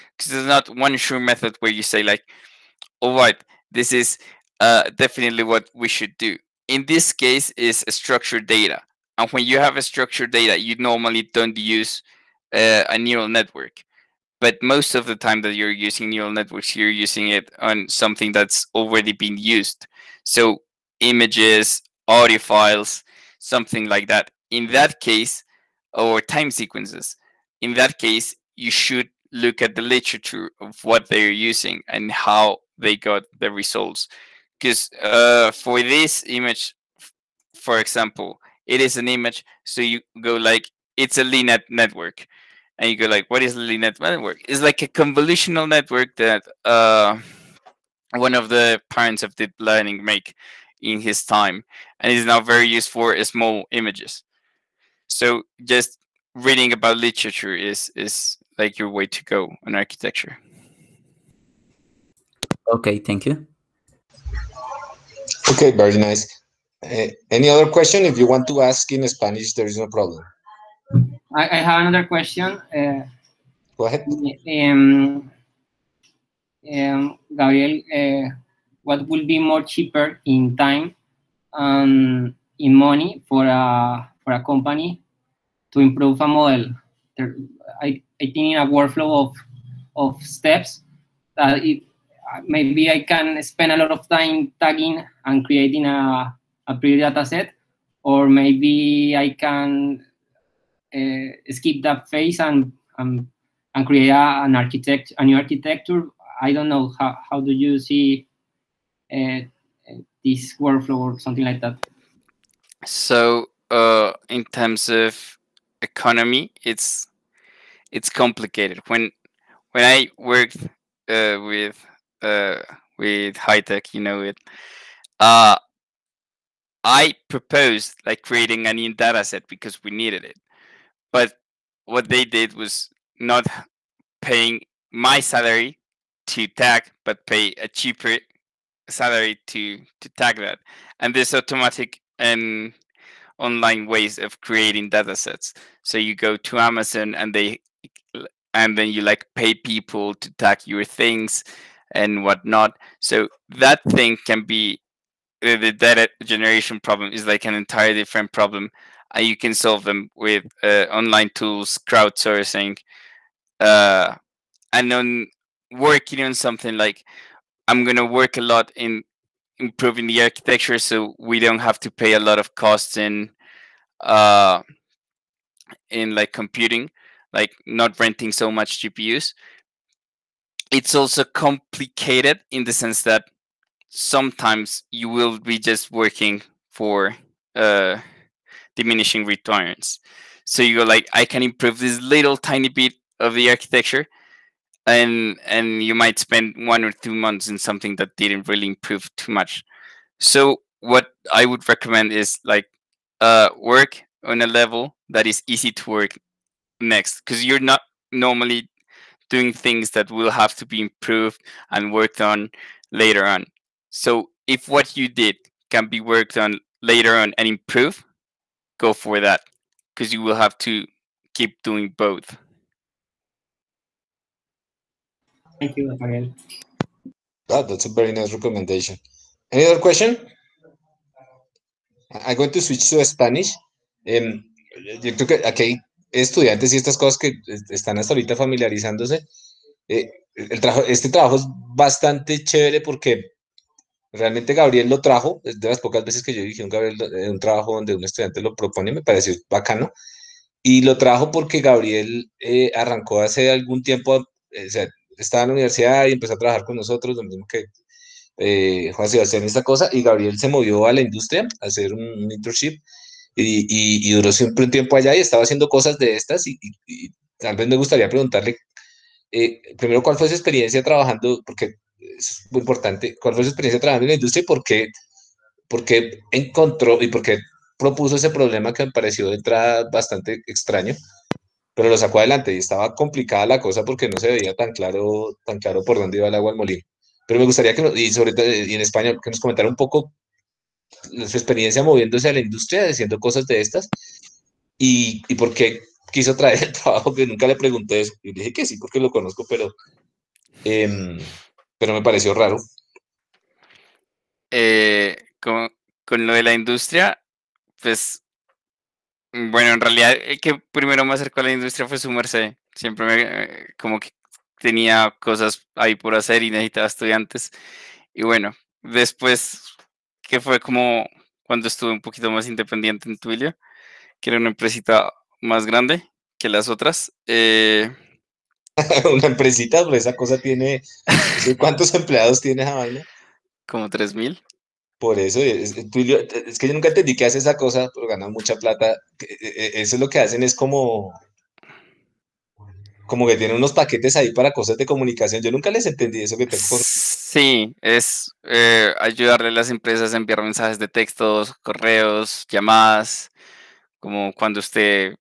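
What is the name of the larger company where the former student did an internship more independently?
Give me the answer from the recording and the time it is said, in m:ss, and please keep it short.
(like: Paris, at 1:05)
Twilio, at 5:23.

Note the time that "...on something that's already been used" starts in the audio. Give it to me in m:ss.
0:17.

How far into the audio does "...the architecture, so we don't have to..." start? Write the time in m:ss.
2:50.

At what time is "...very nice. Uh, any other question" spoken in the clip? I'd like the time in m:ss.
1:05.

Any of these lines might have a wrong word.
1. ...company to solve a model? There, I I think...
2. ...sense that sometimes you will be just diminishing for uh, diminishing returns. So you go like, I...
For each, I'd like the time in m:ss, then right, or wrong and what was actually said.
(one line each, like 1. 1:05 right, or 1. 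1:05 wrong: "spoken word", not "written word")
1. 1:24 wrong: "improve", not "solve"
2. 3:02 wrong: "working", not "diminishing".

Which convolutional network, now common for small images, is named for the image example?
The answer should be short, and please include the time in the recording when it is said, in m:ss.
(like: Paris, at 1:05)
LeNet, at 0:41.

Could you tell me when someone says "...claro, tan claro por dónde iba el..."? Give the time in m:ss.
4:44.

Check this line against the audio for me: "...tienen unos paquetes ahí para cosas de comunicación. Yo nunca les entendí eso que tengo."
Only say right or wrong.
right.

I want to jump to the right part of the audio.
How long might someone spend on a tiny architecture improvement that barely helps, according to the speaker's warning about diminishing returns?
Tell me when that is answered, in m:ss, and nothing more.
3:16.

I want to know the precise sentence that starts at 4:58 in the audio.
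Y dije que sí, porque lo conozco, pero, em, pero me pareció raro.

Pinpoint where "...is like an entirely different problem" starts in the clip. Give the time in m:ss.
2:37.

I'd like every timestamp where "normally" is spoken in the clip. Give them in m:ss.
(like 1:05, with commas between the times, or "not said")
0:10, 3:28.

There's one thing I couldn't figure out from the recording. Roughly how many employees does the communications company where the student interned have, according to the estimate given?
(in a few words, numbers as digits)
3000.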